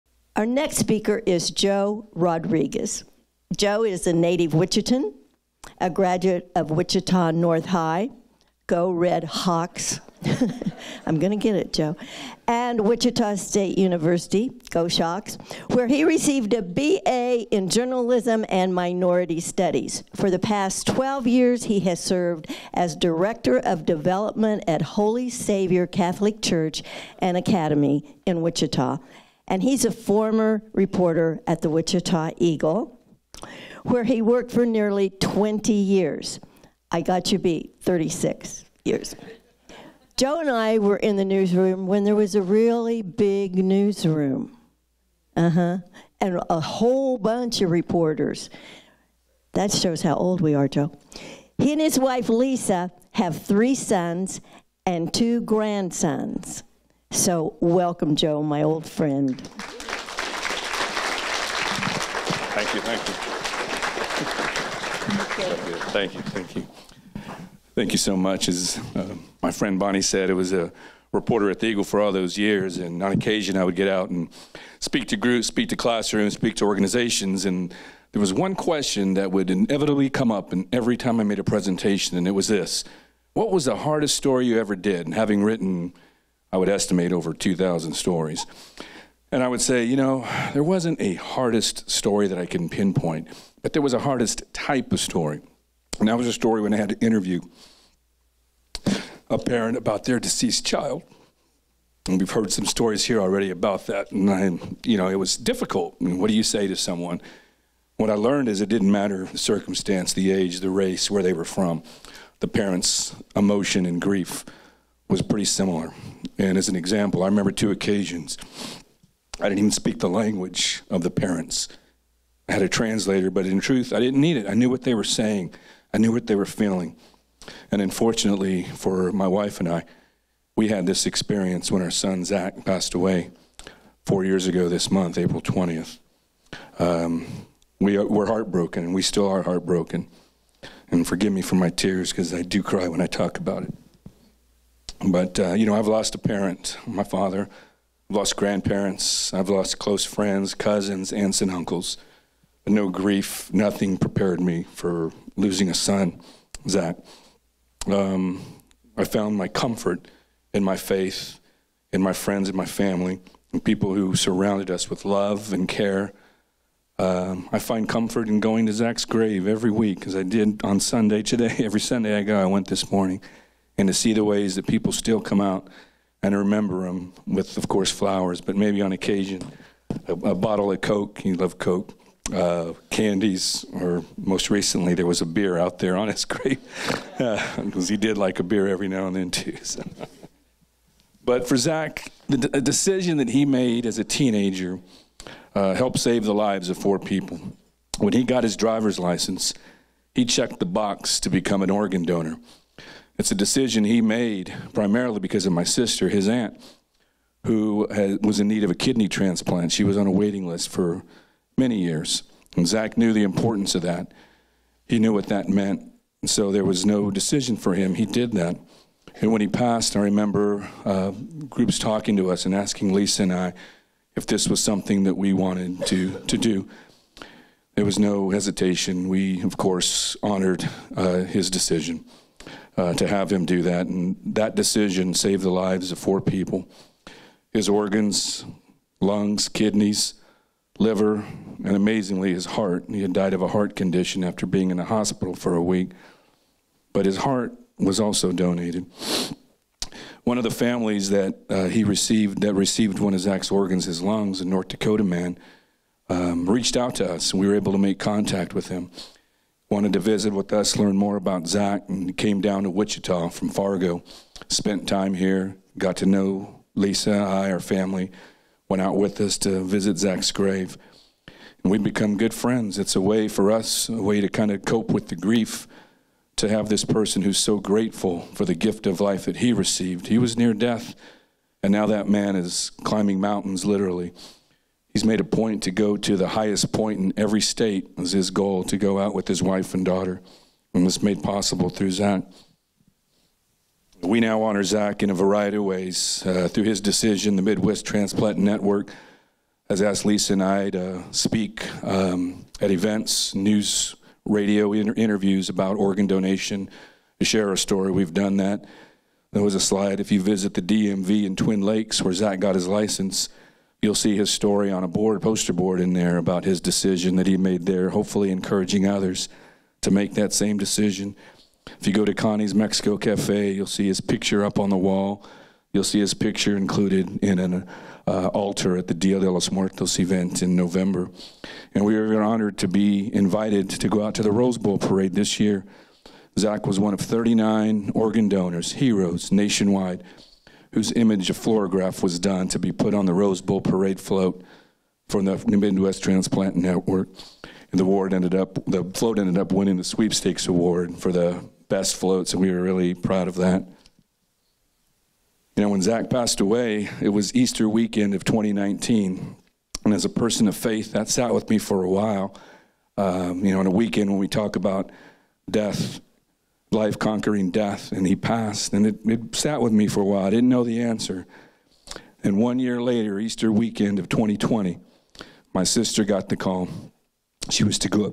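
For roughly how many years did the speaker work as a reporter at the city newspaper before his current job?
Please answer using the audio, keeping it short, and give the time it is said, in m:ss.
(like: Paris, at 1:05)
20, at 0:34.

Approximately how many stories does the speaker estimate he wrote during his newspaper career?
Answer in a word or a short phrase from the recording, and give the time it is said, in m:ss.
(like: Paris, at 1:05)
2,000, at 1:27.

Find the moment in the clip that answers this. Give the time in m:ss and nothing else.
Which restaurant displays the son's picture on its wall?
5:22.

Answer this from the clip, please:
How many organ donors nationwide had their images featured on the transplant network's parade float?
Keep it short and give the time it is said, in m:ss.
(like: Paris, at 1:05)
39, at 5:36.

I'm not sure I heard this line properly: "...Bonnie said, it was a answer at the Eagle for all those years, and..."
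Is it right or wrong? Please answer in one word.
wrong.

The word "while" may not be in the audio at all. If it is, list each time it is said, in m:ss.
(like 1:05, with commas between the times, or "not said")
6:01, 6:10.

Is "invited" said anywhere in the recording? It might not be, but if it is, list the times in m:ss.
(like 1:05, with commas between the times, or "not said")
5:33.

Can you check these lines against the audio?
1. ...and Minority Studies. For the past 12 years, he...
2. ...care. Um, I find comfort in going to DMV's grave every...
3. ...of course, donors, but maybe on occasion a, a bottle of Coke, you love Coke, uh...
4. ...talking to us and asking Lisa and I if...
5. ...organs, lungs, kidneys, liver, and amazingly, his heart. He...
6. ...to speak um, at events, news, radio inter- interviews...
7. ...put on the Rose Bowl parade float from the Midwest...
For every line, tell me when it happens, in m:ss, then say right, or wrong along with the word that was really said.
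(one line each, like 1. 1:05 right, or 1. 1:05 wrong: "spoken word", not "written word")
1. 0:18 right
2. 2:45 wrong: "Zach", not "DMV"
3. 2:57 wrong: "flowers", not "donors"
4. 3:41 right
5. 3:57 right
6. 5:00 right
7. 5:42 right.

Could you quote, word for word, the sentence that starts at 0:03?
Joe is a native Wichita, a graduate of Wichita North High.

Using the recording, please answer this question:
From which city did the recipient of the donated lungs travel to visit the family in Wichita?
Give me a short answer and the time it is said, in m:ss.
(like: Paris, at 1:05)
Fargo, at 4:23.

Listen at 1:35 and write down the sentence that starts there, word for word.
And that was a story when I had to interview a parent about their deceased child.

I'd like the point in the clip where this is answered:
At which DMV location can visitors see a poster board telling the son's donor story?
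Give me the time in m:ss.
5:11.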